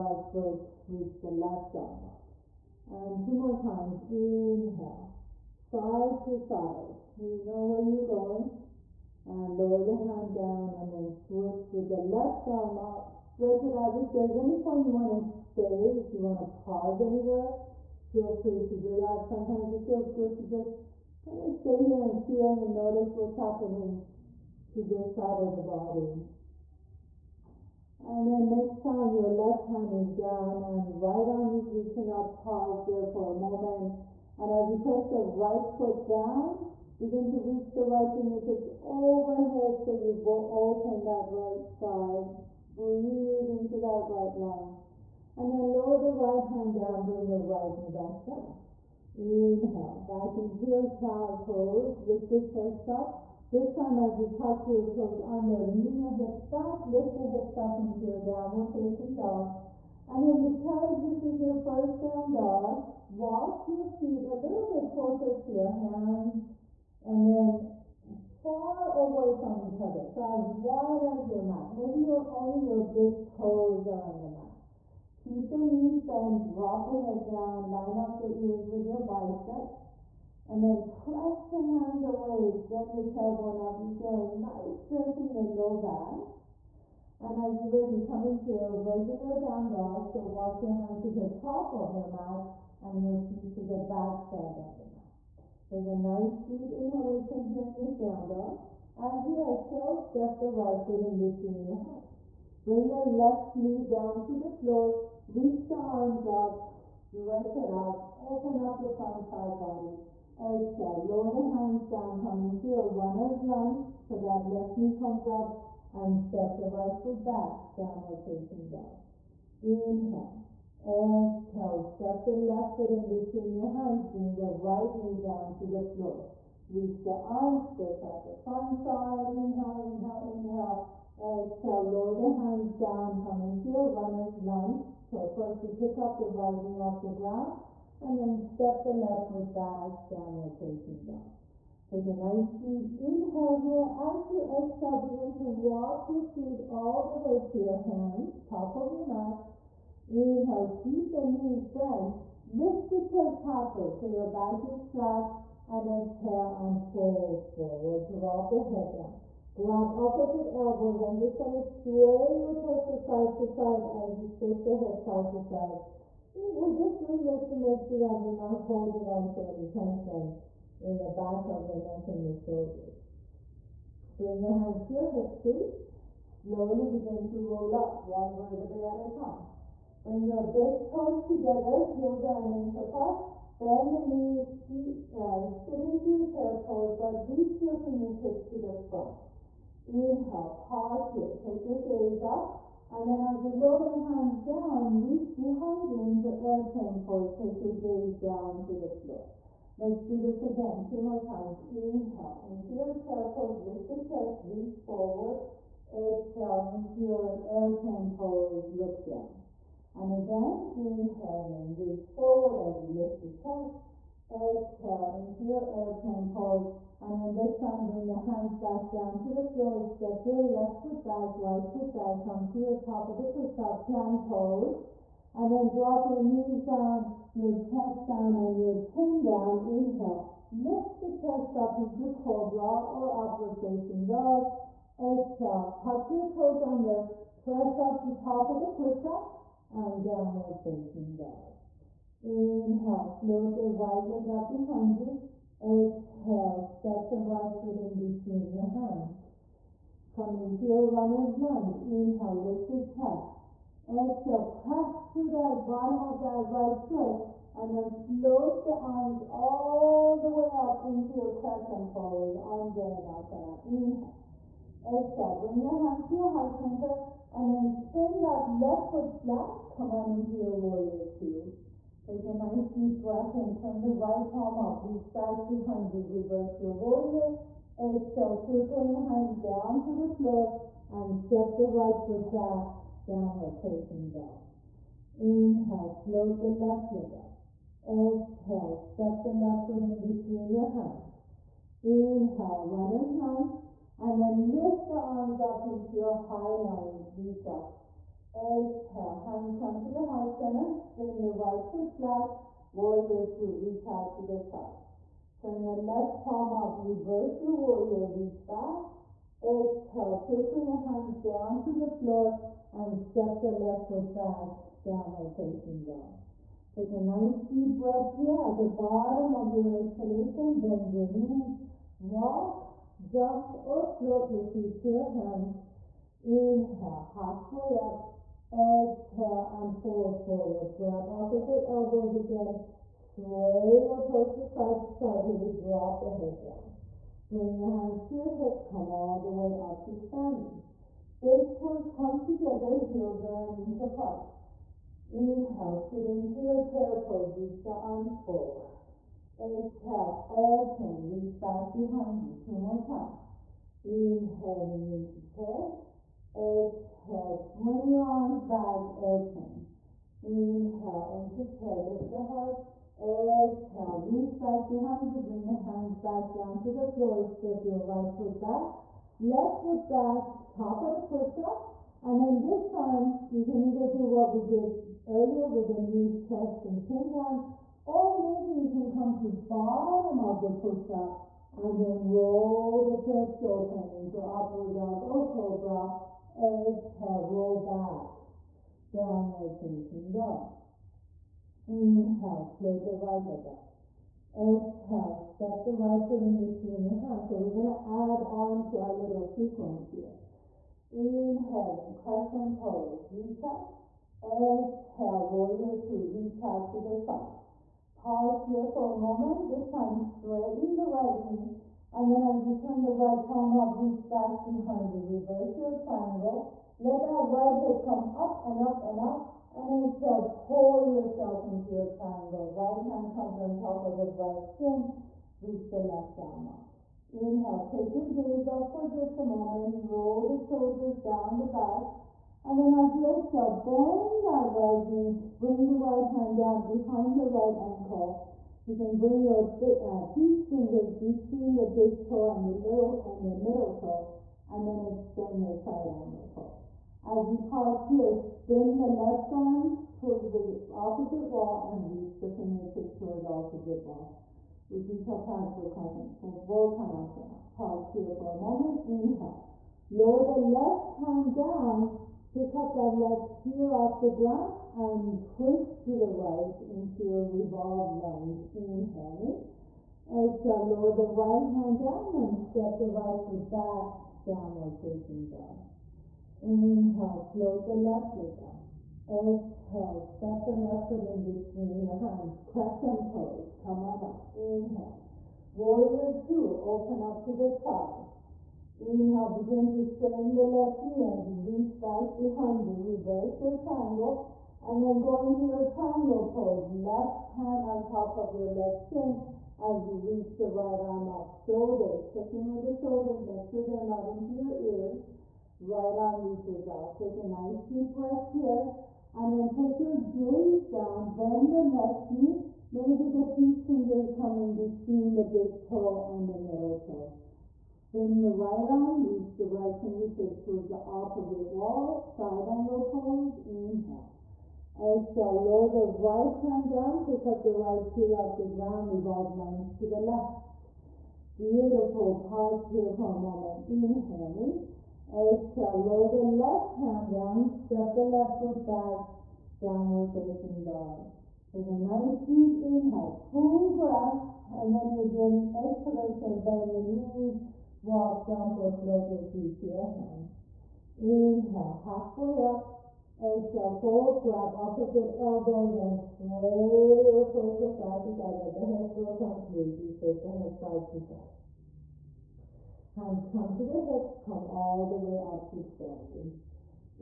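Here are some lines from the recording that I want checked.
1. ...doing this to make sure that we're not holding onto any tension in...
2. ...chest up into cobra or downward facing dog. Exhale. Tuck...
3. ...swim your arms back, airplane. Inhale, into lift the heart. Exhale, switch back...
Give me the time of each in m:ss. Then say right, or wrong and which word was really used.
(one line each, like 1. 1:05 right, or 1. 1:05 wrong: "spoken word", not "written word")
1. 2:47 right
2. 3:51 wrong: "upward", not "downward"
3. 5:57 wrong: "reach", not "switch".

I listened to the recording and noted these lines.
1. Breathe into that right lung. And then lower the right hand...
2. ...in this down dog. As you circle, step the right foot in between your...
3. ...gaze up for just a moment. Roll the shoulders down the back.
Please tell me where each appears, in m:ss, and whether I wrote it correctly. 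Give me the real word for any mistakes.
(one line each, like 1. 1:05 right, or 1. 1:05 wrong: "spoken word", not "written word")
1. 0:42 right
2. 1:37 wrong: "exhale", not "circle"
3. 7:08 right.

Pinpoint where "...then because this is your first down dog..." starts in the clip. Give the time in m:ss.
1:00.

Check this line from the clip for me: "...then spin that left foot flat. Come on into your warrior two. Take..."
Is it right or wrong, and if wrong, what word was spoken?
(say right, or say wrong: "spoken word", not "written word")
right.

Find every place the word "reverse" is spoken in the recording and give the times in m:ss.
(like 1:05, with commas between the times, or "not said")
4:36, 5:06, 6:55, 8:12.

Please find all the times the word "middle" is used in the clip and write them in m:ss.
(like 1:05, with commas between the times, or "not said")
7:23, 8:36.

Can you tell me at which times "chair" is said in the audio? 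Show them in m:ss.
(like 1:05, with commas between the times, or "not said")
3:06, 3:22, 5:46, 5:55.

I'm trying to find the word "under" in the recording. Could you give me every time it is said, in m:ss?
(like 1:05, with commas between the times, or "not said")
0:55, 3:56.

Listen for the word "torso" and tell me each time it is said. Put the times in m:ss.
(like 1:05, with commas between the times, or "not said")
2:42, 5:34, 9:17.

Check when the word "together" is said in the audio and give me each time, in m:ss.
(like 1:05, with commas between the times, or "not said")
3:01, 5:42.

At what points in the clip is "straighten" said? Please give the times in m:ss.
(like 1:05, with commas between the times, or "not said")
6:49, 8:09.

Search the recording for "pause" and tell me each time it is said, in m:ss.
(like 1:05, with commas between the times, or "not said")
0:16, 0:32, 3:10, 6:47, 7:27, 7:37, 8:52.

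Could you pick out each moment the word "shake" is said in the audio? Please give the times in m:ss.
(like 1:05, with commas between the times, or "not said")
2:44, 9:19.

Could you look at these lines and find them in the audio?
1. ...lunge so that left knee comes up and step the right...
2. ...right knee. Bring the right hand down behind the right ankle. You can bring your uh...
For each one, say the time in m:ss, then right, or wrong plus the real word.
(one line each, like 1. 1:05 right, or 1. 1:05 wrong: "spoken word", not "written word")
1. 1:53 right
2. 7:14 right.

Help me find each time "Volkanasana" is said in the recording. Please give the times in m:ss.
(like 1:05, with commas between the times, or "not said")
7:36.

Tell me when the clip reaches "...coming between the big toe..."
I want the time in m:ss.
8:34.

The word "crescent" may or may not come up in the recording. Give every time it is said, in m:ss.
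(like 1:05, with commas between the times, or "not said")
4:21, 6:41, 8:02.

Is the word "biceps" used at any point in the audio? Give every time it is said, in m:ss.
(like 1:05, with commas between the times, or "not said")
1:19.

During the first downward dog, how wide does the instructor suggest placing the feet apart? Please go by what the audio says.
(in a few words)
As wide as your mat.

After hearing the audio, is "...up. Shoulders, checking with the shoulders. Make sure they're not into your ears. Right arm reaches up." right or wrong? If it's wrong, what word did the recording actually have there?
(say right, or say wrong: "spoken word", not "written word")
right.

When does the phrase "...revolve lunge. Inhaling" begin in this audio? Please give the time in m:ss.
7:47.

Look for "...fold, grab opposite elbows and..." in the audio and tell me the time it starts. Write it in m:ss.
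9:13.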